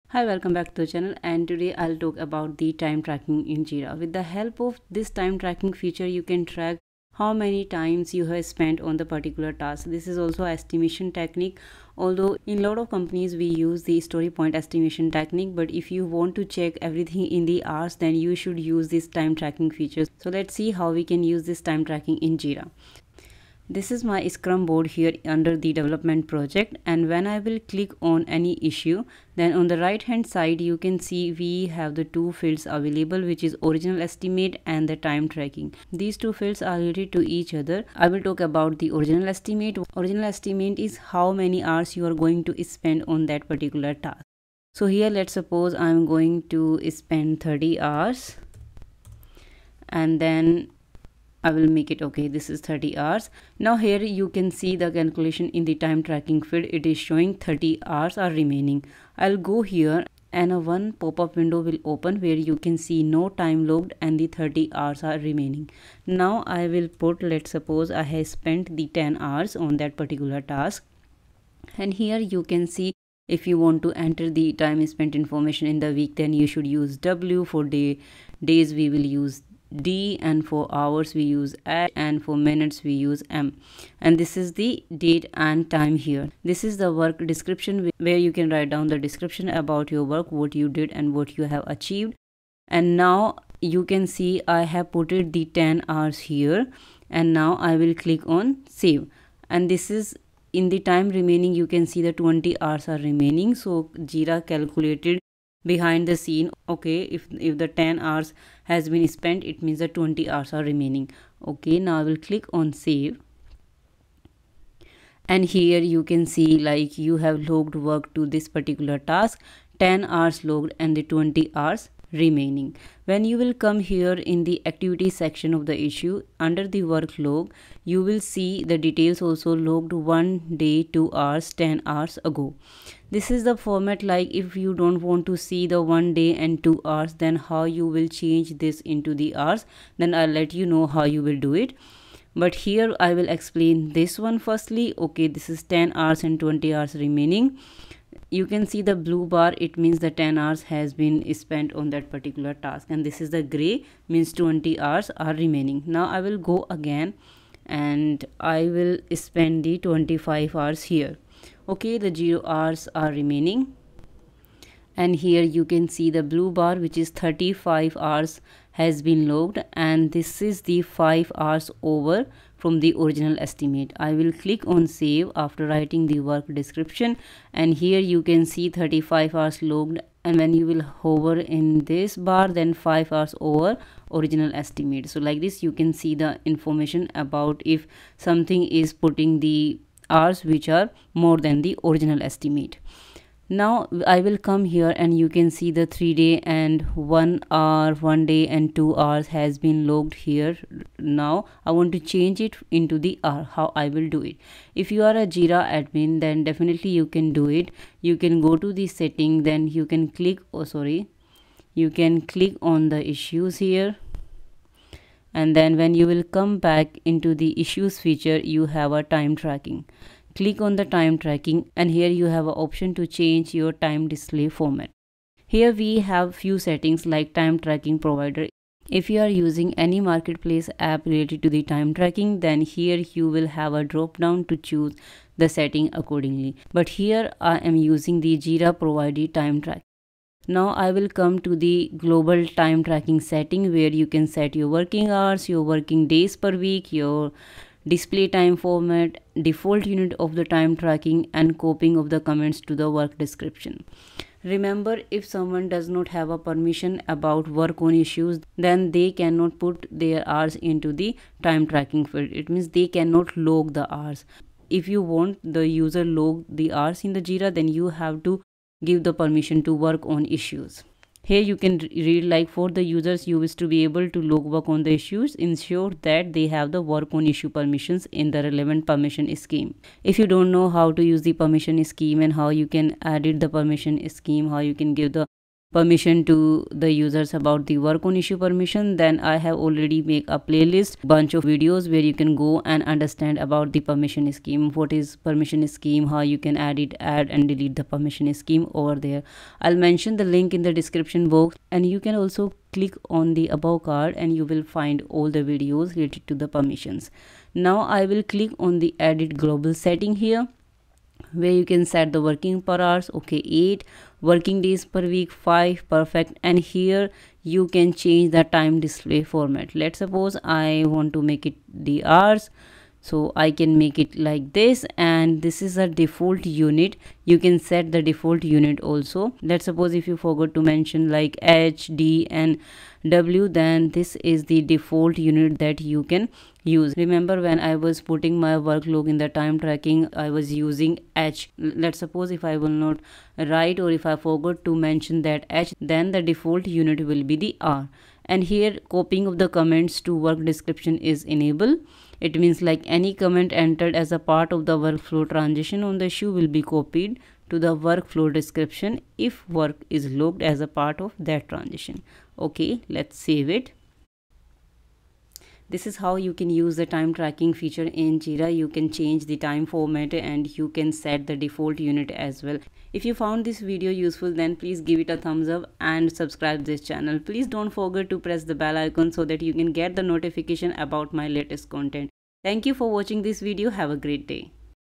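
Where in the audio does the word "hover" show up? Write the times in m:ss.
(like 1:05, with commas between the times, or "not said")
3:00.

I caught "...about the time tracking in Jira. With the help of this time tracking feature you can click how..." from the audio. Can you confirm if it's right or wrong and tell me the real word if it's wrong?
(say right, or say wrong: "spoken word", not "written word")
wrong: "track", not "click".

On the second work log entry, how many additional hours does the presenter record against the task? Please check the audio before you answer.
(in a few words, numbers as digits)
25 hours.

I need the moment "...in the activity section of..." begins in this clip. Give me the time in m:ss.
2:04.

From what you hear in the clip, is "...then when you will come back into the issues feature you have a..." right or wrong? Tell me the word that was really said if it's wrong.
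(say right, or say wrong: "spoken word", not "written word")
right.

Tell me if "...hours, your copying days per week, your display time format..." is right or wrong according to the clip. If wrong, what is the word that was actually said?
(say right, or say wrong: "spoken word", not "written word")
wrong: "working", not "copying".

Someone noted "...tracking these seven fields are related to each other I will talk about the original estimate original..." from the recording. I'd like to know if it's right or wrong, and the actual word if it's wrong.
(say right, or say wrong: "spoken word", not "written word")
wrong: "two", not "seven".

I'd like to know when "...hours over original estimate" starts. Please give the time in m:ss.
3:03.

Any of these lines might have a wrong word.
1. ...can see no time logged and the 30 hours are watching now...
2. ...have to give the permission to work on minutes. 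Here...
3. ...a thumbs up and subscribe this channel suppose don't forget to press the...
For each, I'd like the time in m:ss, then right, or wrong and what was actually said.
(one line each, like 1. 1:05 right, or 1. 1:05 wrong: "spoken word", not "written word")
1. 1:02 wrong: "remaining", not "watching"
2. 4:27 wrong: "issues", not "minutes"
3. 6:15 wrong: "please", not "suppose".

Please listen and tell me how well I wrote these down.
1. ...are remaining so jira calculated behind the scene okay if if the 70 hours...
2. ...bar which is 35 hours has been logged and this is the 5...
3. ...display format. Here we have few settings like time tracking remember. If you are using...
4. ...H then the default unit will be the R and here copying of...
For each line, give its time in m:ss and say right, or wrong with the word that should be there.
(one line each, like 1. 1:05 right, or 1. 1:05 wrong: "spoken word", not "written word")
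1. 1:42 wrong: "10", not "70"
2. 2:46 right
3. 3:44 wrong: "provider", not "remember"
4. 5:45 right.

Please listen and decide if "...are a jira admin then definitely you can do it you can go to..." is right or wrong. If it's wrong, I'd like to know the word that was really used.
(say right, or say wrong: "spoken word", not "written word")
right.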